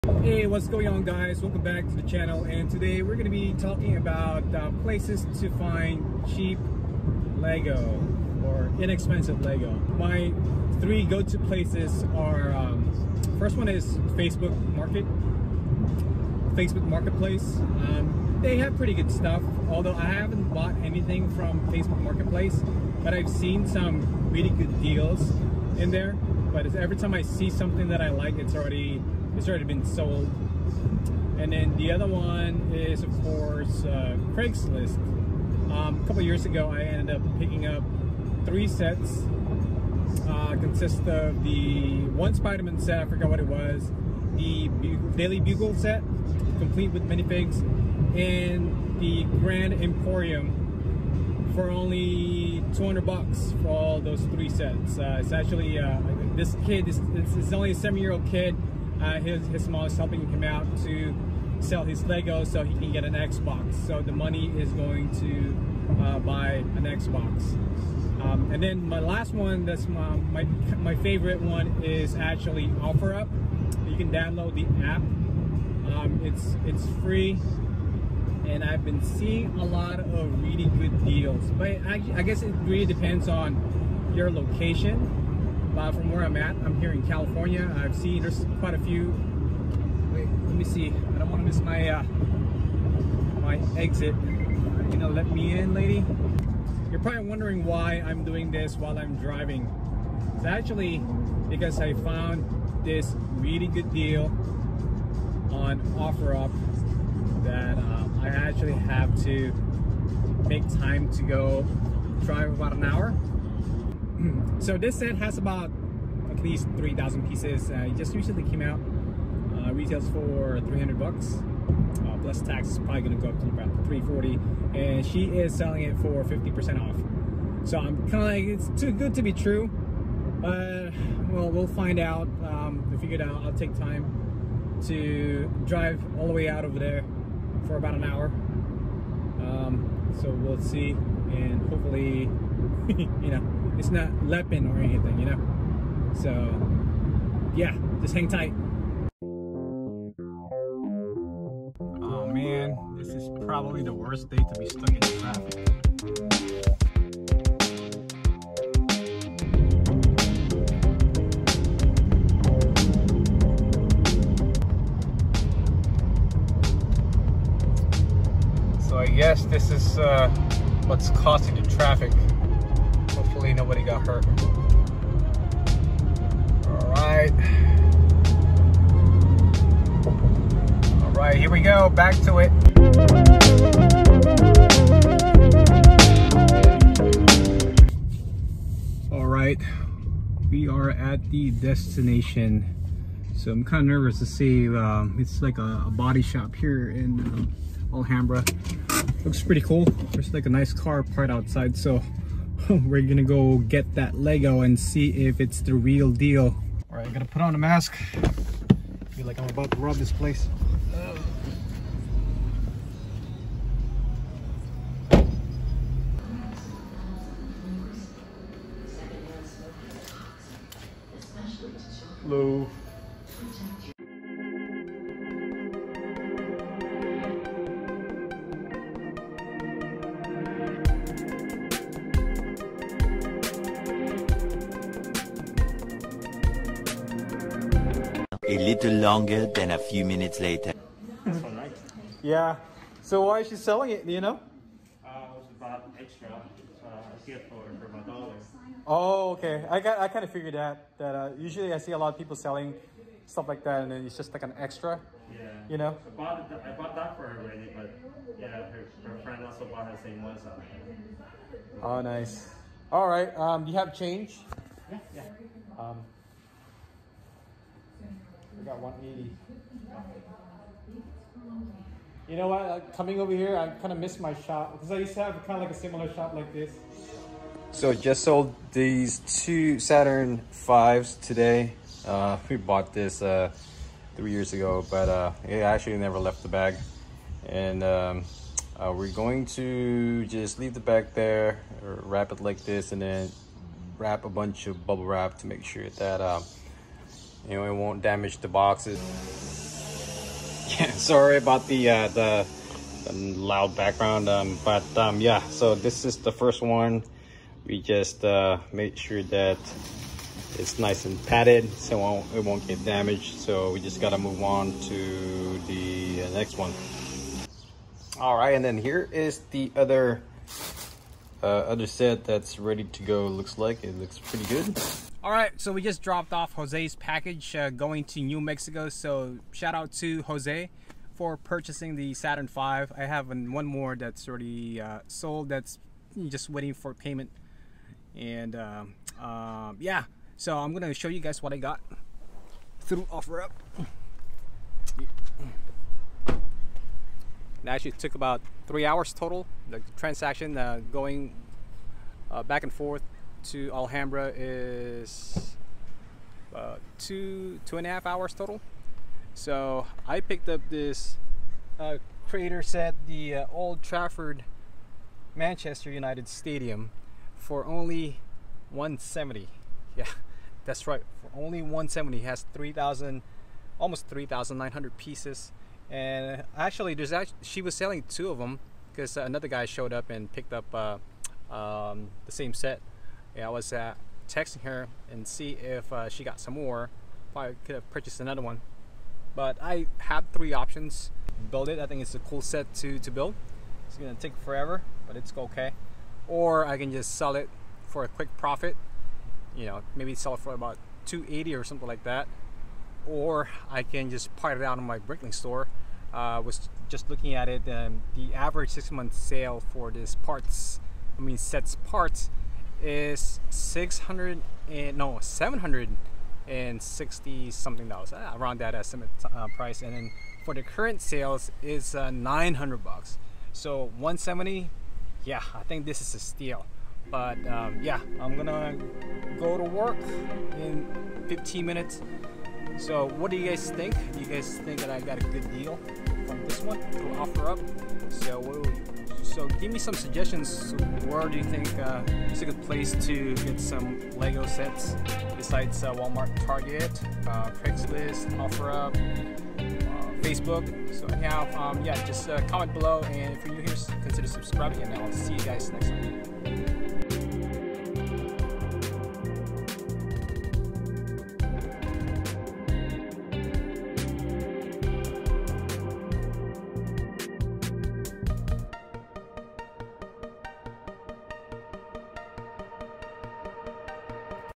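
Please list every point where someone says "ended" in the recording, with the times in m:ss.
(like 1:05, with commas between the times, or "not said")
0:36.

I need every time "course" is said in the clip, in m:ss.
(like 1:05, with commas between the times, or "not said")
0:33.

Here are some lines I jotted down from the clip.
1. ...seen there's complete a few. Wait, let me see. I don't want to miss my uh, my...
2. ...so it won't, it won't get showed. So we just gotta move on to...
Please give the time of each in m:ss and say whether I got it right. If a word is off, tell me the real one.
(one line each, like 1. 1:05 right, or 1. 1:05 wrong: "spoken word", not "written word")
1. 1:27 wrong: "quite", not "complete"
2. 5:11 wrong: "damaged", not "showed".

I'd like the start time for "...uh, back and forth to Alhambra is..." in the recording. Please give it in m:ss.
5:52.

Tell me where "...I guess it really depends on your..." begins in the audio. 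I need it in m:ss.
1:22.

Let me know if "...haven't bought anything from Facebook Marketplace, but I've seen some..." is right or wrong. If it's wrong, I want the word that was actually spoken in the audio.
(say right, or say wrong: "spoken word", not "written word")
right.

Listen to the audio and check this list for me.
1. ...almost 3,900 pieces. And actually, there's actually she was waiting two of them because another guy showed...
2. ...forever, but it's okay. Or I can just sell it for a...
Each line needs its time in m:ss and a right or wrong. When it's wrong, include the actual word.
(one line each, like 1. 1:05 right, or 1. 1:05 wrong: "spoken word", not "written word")
1. 6:13 wrong: "selling", not "waiting"
2. 6:34 right.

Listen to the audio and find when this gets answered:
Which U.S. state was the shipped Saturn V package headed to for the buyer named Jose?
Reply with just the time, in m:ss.
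5:28.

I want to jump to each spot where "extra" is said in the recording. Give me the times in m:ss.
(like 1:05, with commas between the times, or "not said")
4:05, 4:14.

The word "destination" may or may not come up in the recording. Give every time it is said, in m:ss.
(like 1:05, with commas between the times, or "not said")
3:11.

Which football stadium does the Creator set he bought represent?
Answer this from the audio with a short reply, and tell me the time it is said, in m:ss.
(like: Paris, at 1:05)
Old Trafford, at 6:03.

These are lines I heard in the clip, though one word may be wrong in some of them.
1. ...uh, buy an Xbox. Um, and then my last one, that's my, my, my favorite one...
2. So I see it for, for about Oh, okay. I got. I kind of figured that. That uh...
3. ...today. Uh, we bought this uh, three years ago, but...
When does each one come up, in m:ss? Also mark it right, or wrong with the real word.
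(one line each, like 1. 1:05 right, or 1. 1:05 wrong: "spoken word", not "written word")
1. 1:06 right
2. 4:06 right
3. 4:41 right.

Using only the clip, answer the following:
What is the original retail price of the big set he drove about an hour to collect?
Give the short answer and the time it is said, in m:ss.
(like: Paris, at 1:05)
$300, at 2:00.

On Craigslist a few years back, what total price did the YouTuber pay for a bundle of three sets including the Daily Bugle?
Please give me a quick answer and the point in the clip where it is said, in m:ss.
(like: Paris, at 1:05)
$200, at 0:52.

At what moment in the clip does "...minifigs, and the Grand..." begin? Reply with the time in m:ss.
0:47.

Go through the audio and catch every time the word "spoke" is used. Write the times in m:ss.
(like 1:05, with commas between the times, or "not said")
not said.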